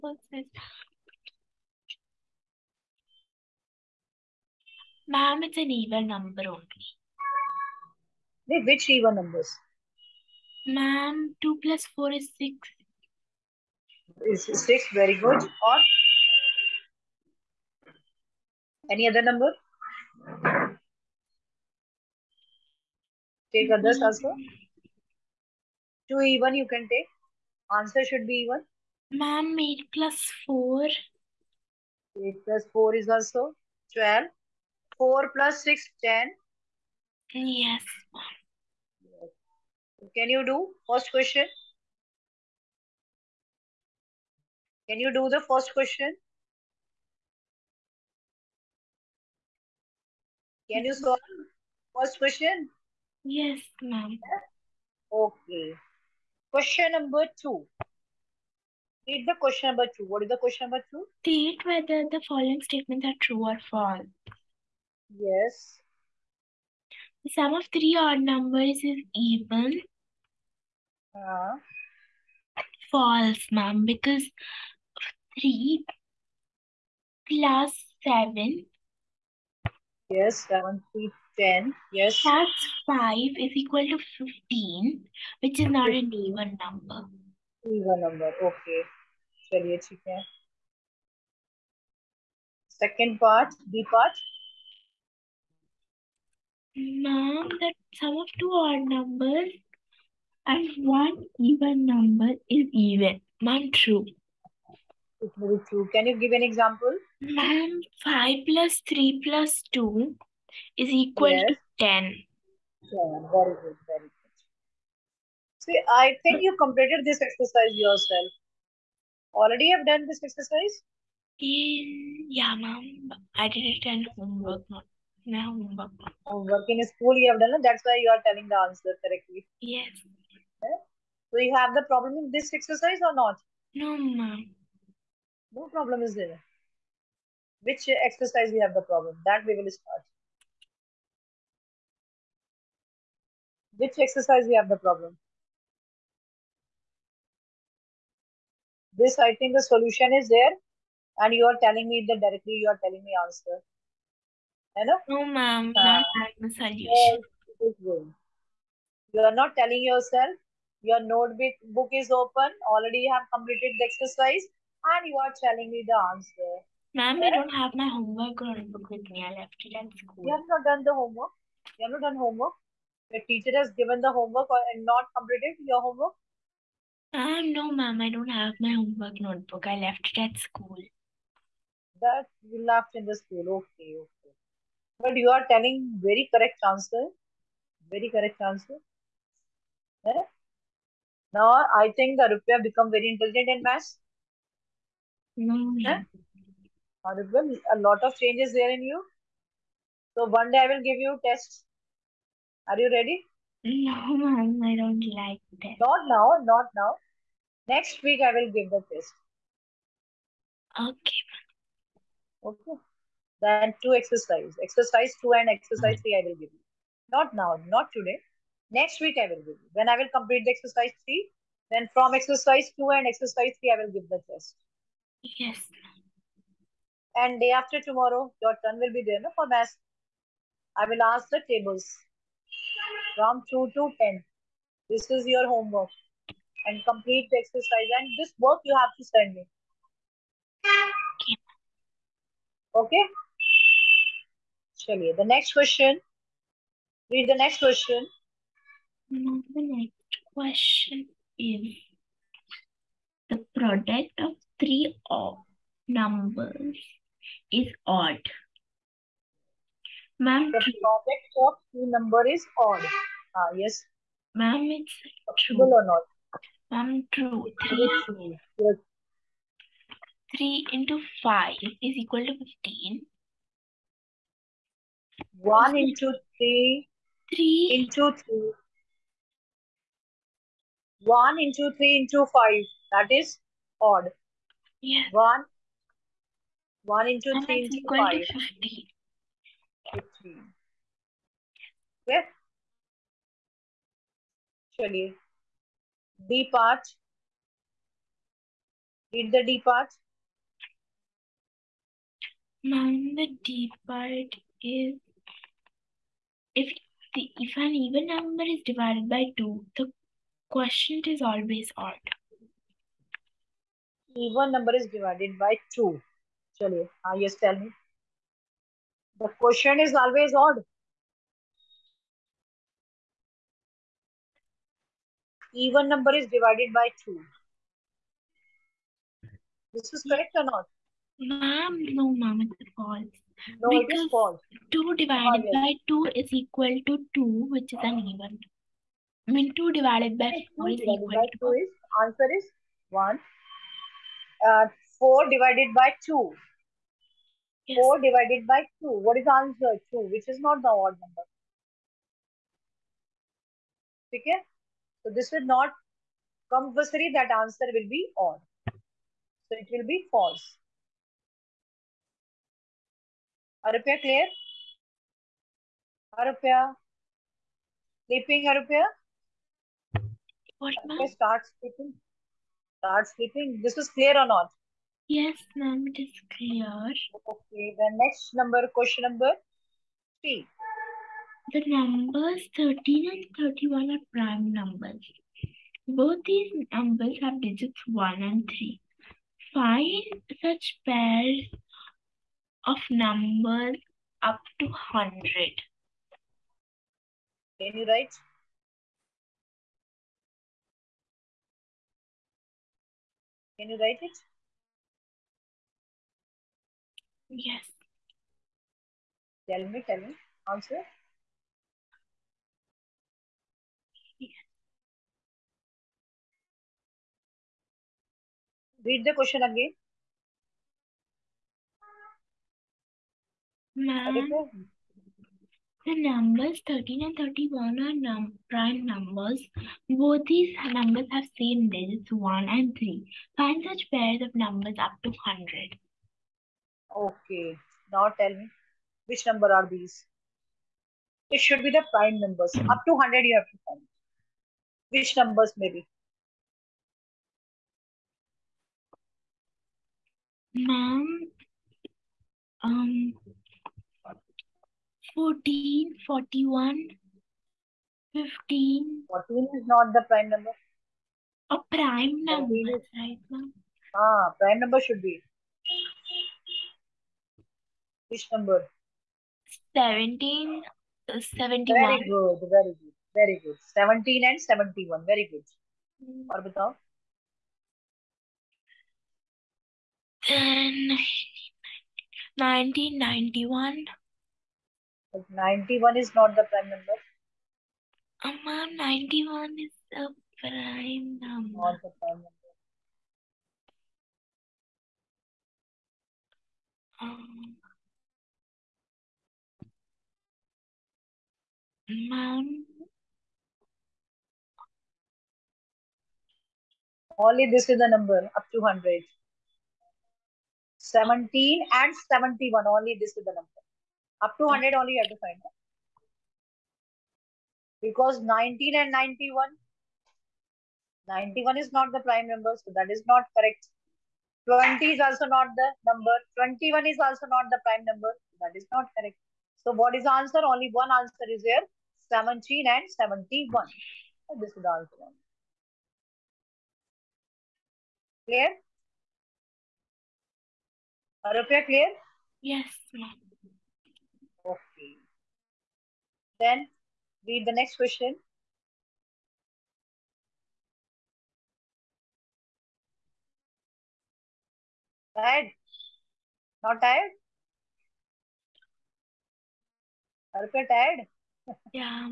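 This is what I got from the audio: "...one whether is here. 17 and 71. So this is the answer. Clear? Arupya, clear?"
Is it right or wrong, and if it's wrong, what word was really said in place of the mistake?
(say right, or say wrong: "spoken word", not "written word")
wrong: "answer", not "whether".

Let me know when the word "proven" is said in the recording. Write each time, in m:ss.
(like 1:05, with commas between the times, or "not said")
not said.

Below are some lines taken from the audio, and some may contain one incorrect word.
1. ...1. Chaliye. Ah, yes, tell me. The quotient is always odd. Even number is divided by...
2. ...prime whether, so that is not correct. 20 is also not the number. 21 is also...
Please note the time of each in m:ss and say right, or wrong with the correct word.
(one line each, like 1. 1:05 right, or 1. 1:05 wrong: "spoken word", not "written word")
1. 5:15 wrong: "2", not "1"
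2. 8:42 wrong: "number", not "whether".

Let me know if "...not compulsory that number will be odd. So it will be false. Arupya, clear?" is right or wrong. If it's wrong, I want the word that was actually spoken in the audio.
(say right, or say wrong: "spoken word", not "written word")
wrong: "answer", not "number".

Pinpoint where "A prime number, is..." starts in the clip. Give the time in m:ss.
7:41.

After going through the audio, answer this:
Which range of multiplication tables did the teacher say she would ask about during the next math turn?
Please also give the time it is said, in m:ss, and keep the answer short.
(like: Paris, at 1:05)
2 to 10, at 3:53.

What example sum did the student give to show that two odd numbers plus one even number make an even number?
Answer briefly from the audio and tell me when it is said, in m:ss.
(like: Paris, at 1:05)
5 plus 3 plus 2, at 1:48.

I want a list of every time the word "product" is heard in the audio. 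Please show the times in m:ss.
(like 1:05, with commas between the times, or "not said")
4:13, 4:20.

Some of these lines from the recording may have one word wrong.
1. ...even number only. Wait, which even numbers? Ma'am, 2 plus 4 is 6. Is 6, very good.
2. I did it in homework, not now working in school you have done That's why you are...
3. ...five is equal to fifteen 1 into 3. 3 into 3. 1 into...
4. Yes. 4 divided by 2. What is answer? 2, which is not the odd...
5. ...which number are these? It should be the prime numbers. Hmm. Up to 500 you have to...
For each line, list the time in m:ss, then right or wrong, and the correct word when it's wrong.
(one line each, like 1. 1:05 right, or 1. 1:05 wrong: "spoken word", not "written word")
1. 0:05 right
2. 2:03 right
3. 4:31 right
4. 5:47 right
5. 7:19 wrong: "100", not "500".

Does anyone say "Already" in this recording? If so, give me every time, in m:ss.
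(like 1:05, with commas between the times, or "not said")
1:59, 2:42.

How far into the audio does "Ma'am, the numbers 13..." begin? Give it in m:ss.
7:03.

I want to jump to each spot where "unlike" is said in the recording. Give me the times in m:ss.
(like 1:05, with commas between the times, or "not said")
not said.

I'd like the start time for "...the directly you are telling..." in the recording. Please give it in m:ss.
2:32.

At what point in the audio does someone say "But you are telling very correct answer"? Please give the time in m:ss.
3:05.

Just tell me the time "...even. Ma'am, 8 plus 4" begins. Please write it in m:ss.
0:28.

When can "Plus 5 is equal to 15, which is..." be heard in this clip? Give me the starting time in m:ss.
1:22.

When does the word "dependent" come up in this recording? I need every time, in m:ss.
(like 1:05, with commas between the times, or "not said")
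not said.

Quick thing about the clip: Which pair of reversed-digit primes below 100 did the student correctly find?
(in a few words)
17 and 71.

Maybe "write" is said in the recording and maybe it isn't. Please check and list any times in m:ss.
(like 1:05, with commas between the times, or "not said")
6:37, 6:43.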